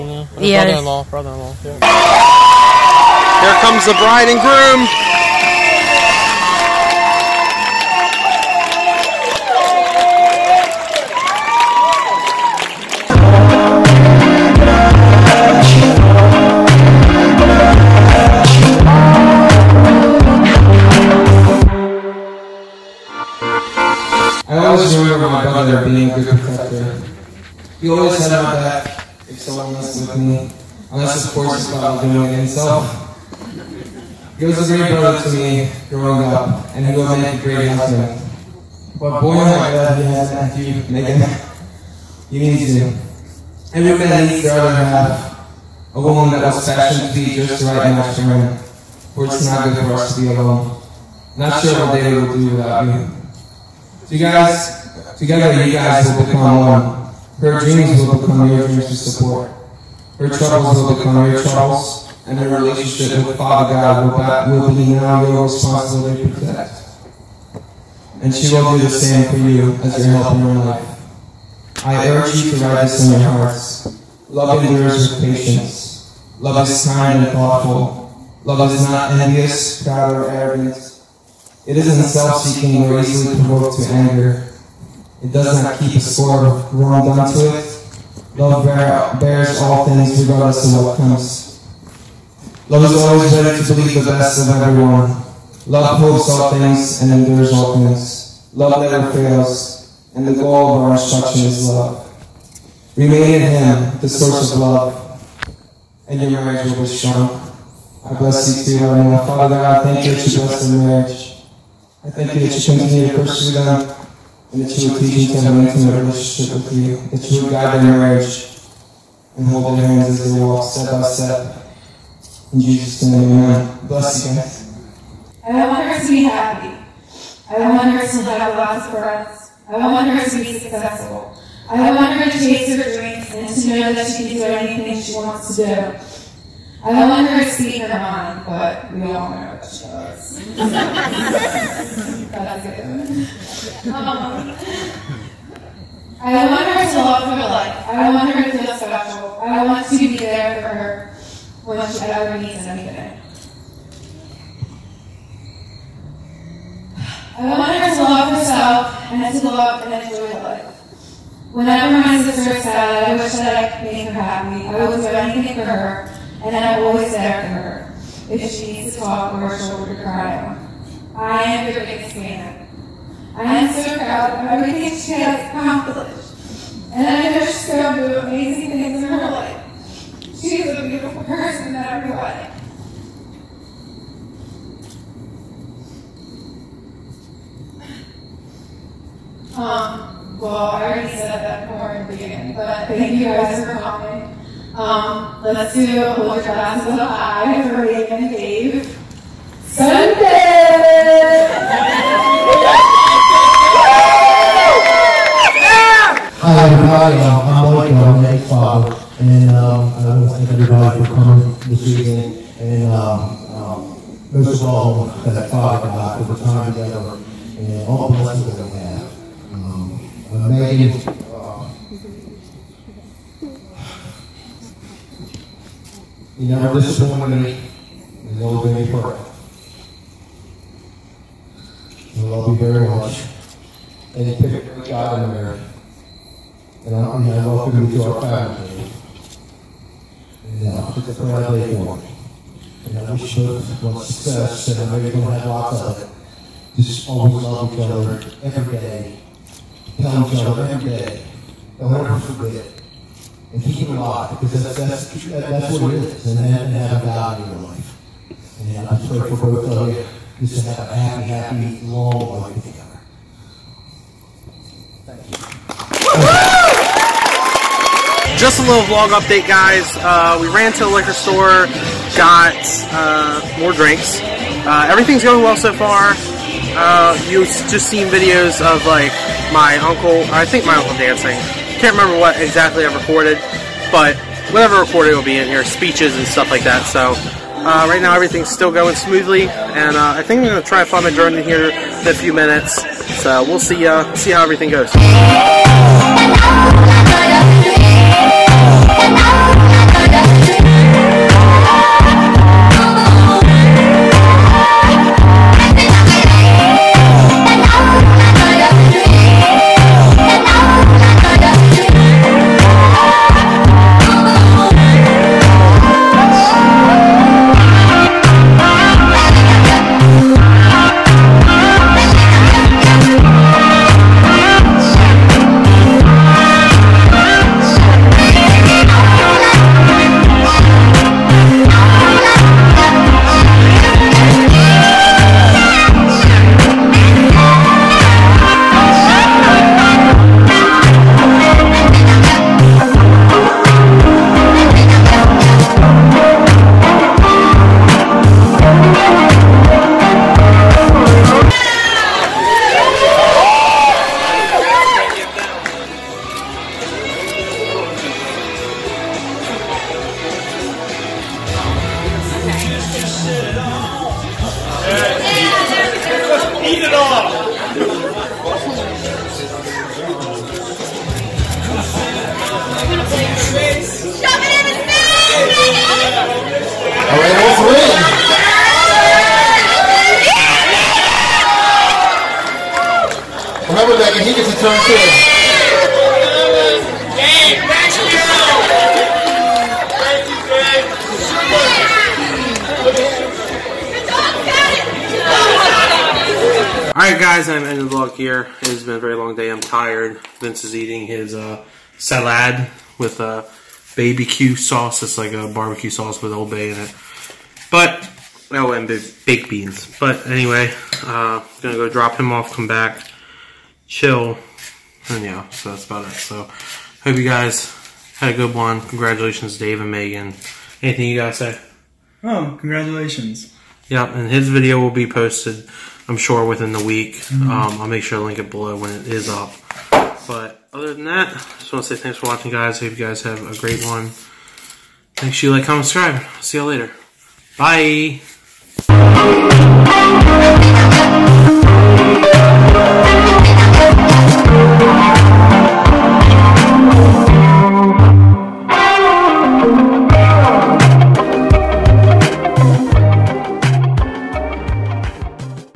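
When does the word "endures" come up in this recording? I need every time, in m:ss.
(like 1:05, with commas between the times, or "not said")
1:14, 1:37.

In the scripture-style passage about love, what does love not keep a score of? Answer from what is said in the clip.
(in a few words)
wrong done to it.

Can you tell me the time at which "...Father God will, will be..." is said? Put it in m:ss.
1:03.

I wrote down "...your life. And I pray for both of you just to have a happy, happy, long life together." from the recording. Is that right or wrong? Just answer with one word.
right.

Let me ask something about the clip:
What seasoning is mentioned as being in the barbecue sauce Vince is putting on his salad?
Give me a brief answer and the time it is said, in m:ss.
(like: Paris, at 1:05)
Old Bay, at 6:46.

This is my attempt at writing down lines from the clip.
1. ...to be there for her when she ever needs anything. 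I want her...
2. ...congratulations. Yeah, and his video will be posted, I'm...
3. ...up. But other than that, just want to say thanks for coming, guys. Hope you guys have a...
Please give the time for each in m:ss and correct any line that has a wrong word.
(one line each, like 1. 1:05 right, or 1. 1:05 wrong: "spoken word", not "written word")
1. 2:29 right
2. 7:02 right
3. 7:09 wrong: "watching", not "coming".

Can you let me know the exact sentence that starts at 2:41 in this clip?
Whenever my sister is sad, I wish that I could make her happy.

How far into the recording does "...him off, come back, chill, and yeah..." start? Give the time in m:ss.
6:52.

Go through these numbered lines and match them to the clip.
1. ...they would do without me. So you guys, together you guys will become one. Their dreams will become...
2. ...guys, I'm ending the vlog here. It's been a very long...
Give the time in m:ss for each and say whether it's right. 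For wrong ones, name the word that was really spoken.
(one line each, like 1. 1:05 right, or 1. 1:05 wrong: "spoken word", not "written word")
1. 0:51 right
2. 6:37 right.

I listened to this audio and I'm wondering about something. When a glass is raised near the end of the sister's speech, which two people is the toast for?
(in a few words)
Megan and Dave.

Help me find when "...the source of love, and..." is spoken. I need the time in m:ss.
1:44.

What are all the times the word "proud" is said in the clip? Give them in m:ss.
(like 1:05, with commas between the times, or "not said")
1:19, 2:53.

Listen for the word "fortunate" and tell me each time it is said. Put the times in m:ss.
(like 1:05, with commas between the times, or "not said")
not said.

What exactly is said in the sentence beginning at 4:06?
Just always love each other every day.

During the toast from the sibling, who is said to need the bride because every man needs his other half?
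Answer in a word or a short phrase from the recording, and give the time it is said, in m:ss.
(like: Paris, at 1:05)
Matthew, at 0:40.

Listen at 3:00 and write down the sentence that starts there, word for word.
She is a beautiful person in every way.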